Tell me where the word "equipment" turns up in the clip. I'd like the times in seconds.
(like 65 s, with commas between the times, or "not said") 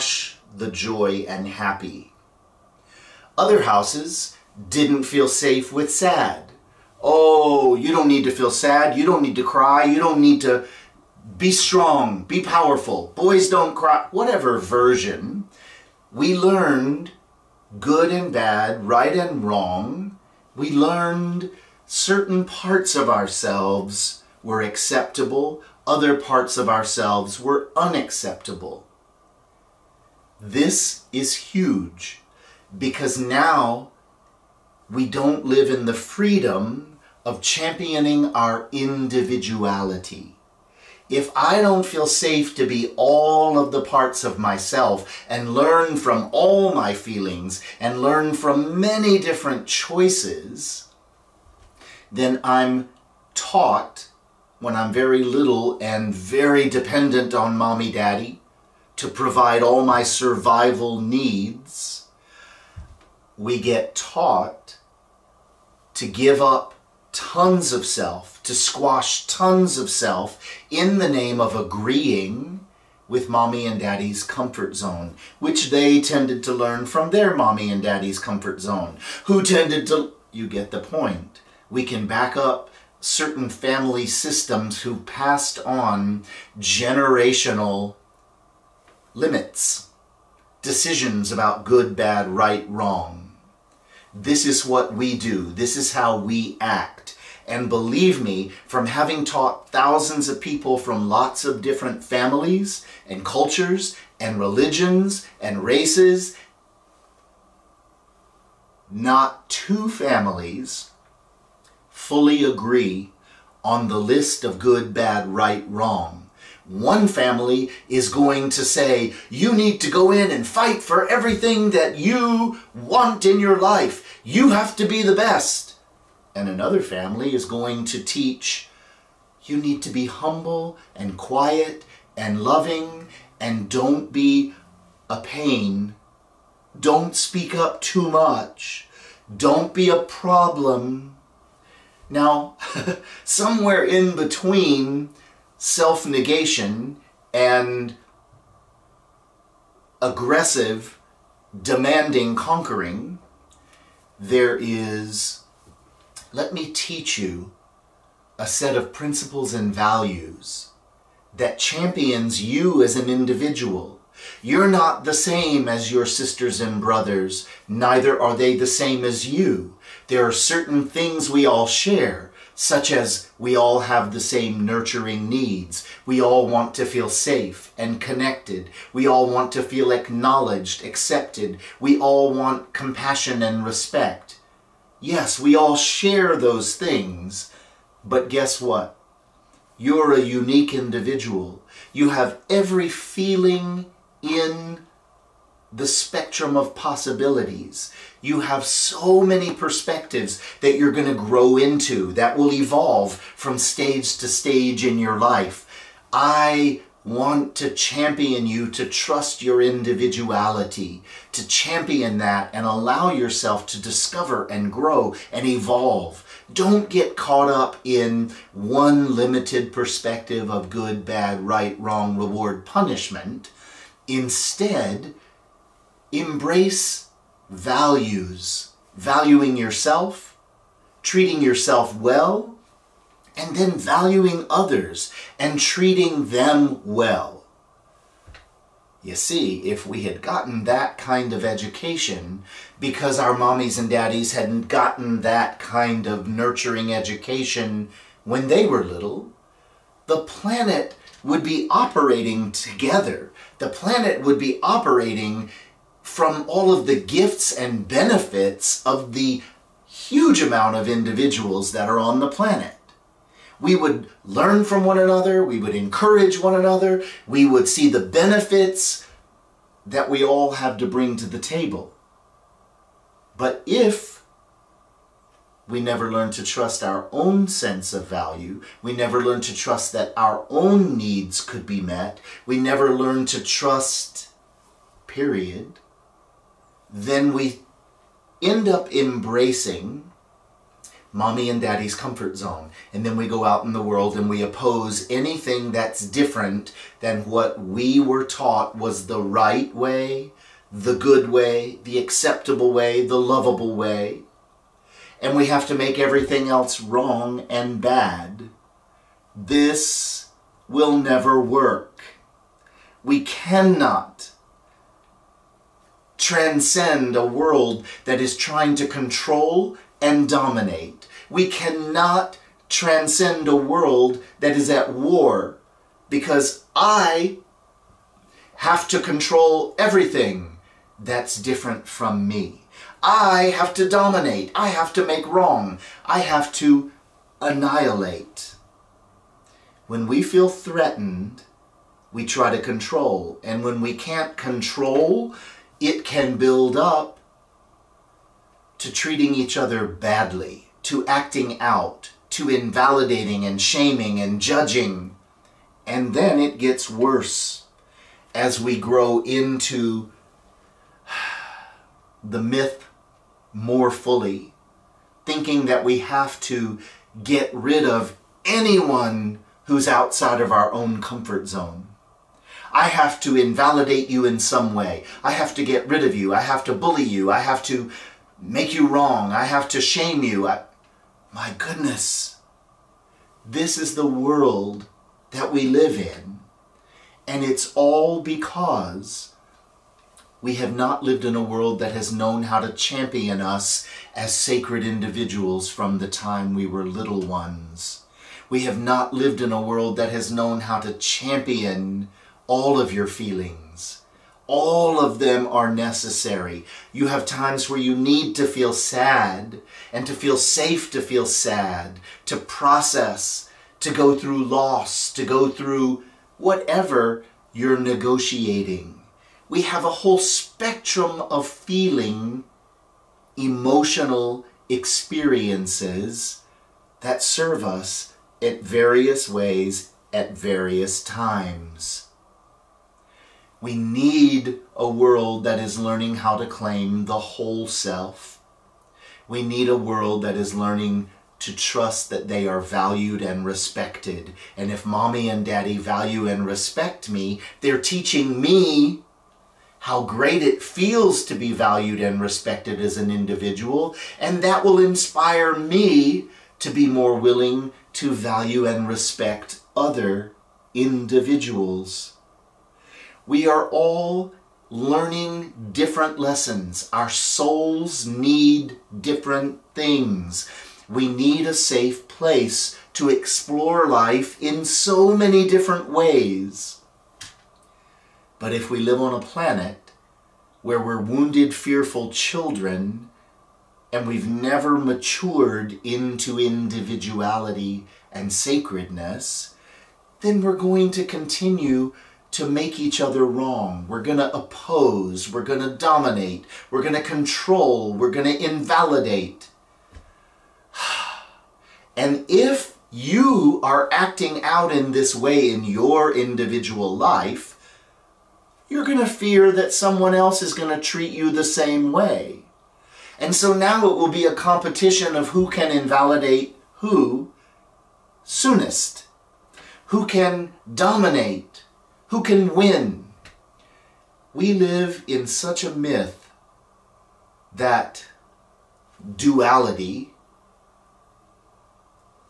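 not said.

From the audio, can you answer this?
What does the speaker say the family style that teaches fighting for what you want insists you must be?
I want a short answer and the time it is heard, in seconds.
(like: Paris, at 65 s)
the best, at 125 s.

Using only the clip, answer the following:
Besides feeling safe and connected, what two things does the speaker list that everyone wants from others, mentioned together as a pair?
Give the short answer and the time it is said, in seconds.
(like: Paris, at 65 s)
compassion and respect, at 182 s.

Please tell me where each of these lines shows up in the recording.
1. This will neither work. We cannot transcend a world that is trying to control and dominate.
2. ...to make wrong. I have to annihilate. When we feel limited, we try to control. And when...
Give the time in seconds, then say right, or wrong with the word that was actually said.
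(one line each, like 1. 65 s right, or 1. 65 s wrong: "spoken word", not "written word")
1. 309 s wrong: "never", not "neither"
2. 334 s wrong: "threatened", not "limited".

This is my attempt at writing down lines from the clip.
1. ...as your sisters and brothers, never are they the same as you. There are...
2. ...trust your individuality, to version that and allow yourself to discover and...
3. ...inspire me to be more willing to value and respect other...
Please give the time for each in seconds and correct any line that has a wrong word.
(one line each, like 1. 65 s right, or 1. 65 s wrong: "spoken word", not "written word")
1. 165 s wrong: "neither", not "never"
2. 208 s wrong: "champion", not "version"
3. 454 s right.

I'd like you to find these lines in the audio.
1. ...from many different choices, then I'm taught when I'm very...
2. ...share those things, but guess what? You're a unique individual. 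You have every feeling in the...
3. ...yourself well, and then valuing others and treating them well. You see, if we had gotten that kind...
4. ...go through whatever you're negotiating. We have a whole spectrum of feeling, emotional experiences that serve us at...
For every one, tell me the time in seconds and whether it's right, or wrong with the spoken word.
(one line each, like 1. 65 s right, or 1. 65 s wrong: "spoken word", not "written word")
1. 48 s right
2. 185 s right
3. 231 s right
4. 415 s right.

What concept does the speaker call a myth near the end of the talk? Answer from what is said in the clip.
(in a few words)
duality.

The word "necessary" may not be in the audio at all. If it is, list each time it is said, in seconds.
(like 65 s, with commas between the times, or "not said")
405 s.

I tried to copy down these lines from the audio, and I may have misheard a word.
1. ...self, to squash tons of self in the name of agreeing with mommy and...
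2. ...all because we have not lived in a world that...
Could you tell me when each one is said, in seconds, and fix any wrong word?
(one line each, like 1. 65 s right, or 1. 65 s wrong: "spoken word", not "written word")
1. 67 s right
2. 387 s right.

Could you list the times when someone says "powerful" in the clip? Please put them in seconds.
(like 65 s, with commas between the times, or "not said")
12 s.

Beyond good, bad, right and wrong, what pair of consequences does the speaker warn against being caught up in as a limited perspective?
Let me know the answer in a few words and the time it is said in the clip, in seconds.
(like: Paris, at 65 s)
reward, punishment, at 222 s.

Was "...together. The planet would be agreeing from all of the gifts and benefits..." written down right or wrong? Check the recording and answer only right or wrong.
wrong.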